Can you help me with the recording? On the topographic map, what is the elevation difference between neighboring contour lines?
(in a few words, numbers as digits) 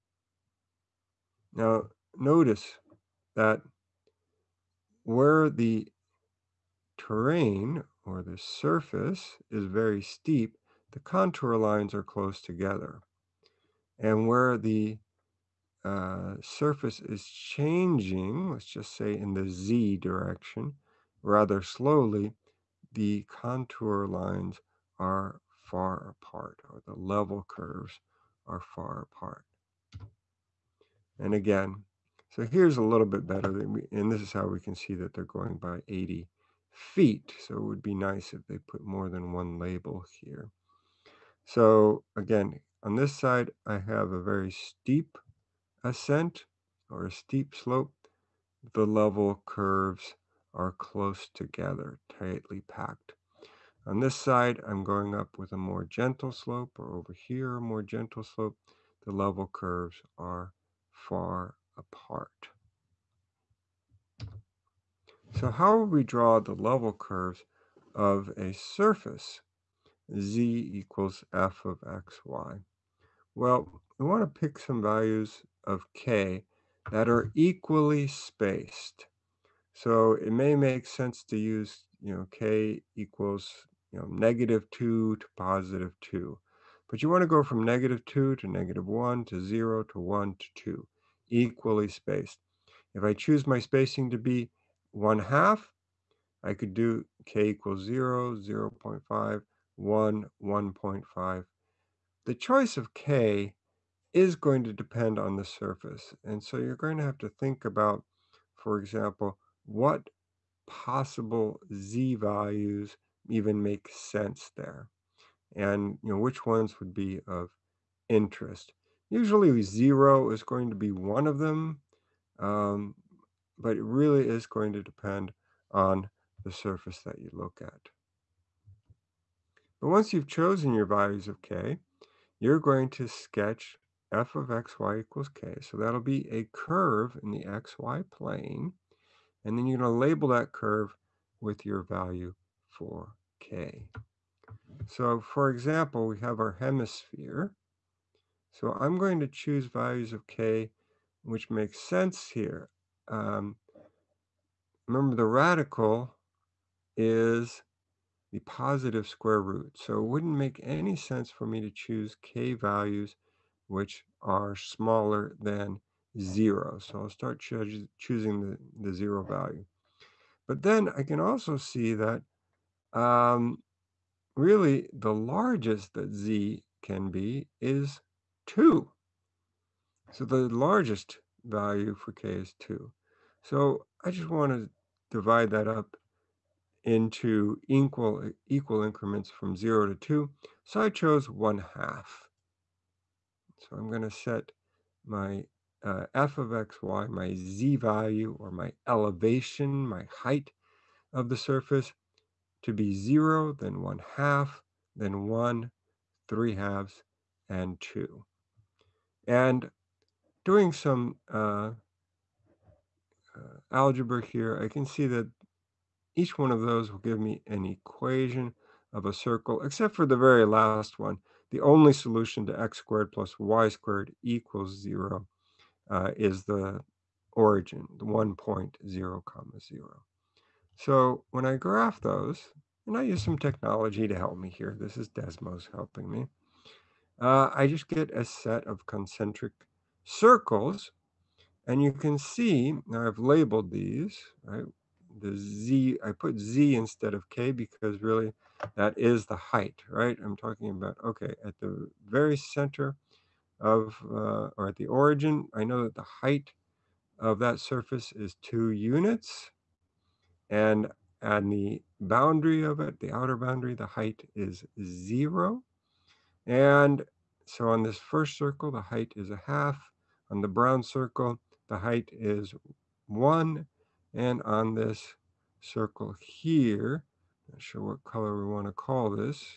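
80 feet.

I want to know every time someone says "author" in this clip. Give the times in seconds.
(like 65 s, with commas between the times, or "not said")
not said.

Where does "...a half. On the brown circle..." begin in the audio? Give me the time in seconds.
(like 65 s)
269 s.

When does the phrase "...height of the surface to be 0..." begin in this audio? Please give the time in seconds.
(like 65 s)
200 s.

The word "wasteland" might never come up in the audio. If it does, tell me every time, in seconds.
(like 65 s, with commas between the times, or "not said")
not said.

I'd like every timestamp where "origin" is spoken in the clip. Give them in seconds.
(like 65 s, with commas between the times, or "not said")
227 s, 254 s.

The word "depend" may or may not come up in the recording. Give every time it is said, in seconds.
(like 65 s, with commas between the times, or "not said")
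104 s, 124 s.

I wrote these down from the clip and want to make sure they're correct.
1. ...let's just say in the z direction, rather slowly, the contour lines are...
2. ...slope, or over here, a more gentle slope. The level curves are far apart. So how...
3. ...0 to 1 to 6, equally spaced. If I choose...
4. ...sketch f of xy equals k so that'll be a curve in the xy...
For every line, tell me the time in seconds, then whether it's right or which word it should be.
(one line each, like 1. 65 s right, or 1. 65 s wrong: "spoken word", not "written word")
1. 18 s right
2. 56 s right
3. 89 s wrong: "2", not "6"
4. 133 s right.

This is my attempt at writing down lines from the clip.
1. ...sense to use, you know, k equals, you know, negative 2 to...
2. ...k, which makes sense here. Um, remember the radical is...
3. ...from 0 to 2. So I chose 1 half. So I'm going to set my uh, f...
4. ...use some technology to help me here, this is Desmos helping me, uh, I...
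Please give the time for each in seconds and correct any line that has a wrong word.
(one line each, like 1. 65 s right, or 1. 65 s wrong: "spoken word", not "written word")
1. 80 s right
2. 150 s right
3. 189 s right
4. 233 s right.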